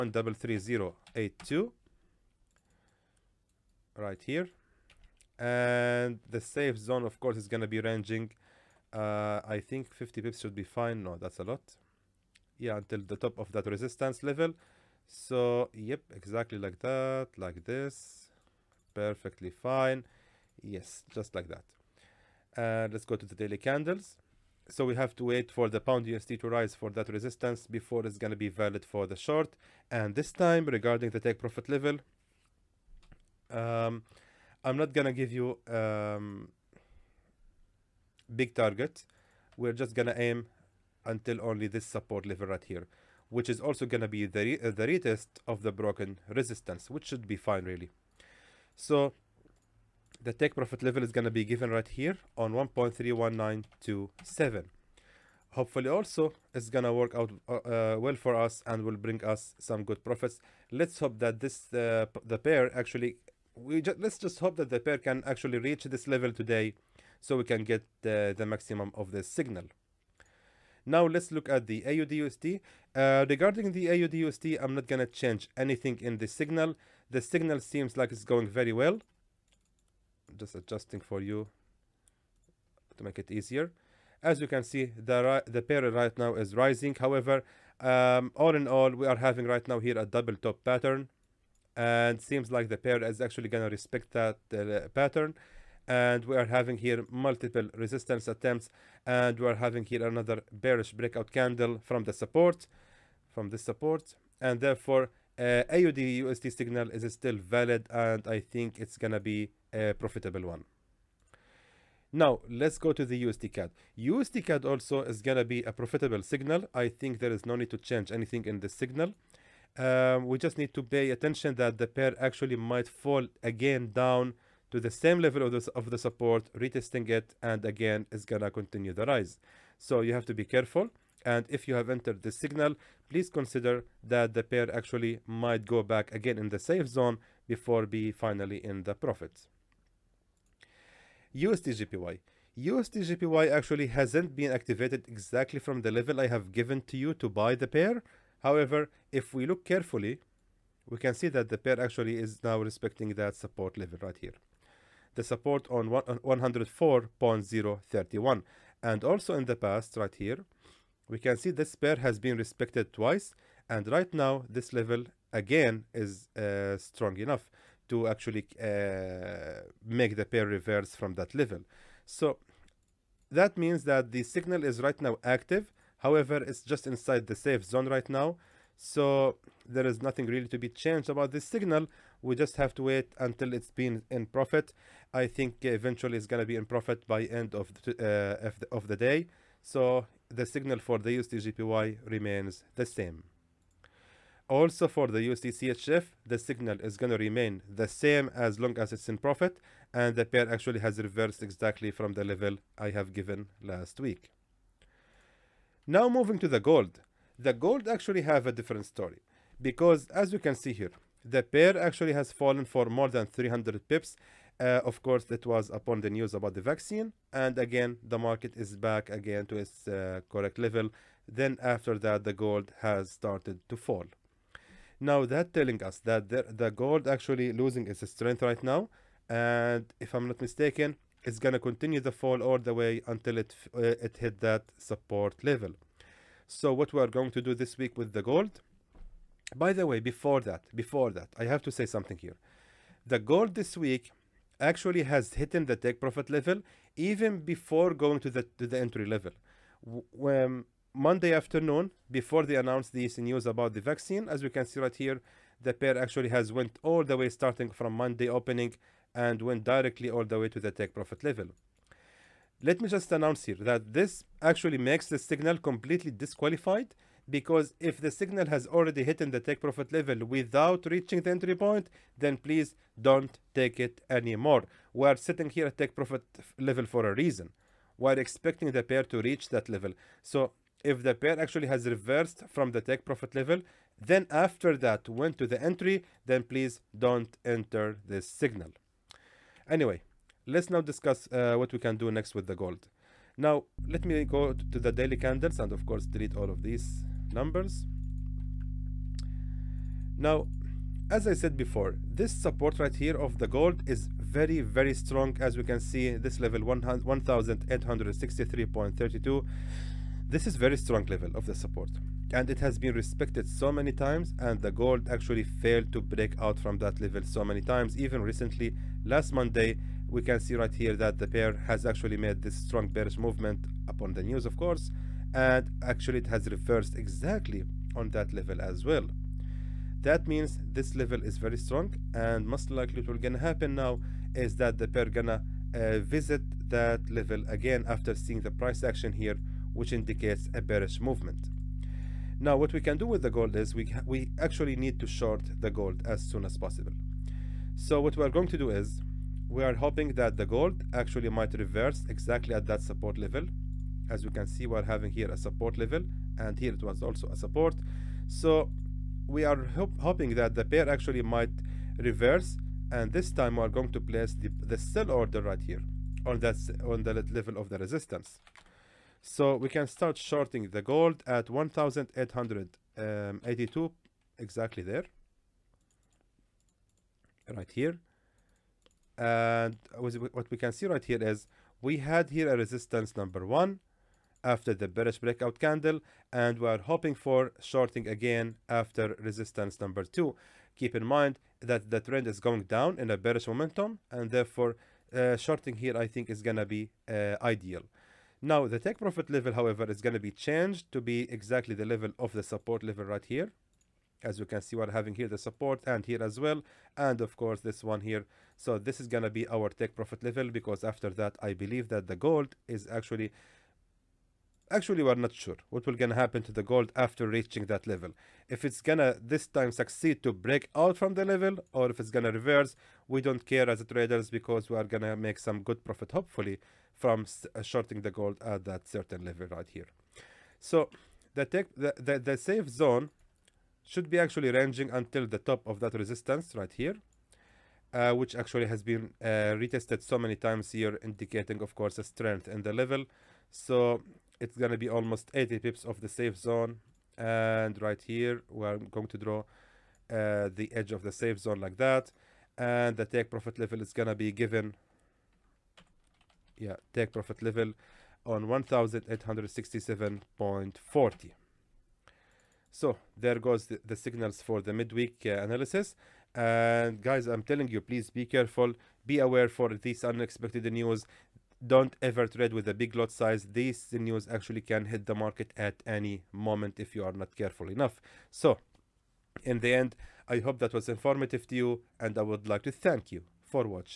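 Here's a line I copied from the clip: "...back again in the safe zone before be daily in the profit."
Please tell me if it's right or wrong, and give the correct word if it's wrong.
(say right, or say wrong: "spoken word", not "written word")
wrong: "finally", not "daily".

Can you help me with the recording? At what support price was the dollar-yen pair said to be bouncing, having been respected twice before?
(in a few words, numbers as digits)
104.031.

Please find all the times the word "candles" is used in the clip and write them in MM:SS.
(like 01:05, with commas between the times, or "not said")
00:23, 01:41, 04:55, 06:25.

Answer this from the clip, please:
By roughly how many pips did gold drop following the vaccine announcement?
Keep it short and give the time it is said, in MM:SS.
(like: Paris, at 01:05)
300, at 03:33.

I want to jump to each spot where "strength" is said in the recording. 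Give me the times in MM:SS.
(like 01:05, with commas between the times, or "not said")
03:48, 07:22.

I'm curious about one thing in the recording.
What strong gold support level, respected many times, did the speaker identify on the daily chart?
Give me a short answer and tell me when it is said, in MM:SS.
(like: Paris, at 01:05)
1863.32, at 05:06.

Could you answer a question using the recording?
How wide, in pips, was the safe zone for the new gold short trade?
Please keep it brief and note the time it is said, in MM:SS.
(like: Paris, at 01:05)
80 pips, at 07:25.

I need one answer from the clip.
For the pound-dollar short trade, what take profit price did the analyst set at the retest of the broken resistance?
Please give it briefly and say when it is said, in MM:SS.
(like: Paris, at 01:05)
1.31927, at 00:52.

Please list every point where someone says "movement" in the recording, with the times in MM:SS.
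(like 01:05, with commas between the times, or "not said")
05:23, 05:41.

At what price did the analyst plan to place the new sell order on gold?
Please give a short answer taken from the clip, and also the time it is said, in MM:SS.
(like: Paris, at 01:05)
1,882, at 06:11.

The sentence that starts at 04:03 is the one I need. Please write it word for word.
The gold this week actually has hit in the take profit level even before going to the to the entry level.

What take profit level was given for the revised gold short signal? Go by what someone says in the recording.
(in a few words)
1867.40.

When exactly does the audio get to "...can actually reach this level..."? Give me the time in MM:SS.
01:04.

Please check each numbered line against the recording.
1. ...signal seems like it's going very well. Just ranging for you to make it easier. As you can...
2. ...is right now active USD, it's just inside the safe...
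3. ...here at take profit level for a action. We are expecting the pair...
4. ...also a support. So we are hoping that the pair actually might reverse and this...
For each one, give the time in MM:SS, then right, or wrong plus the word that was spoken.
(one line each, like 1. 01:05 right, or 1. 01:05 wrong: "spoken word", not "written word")
1. 01:17 wrong: "adjusting", not "ranging"
2. 02:54 wrong: "However", not "USD"
3. 04:35 wrong: "reason", not "action"
4. 05:57 right.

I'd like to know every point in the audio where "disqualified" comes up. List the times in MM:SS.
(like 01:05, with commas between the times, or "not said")
04:26.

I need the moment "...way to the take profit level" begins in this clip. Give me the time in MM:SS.
04:20.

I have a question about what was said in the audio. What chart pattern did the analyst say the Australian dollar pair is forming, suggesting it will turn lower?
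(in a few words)
double top.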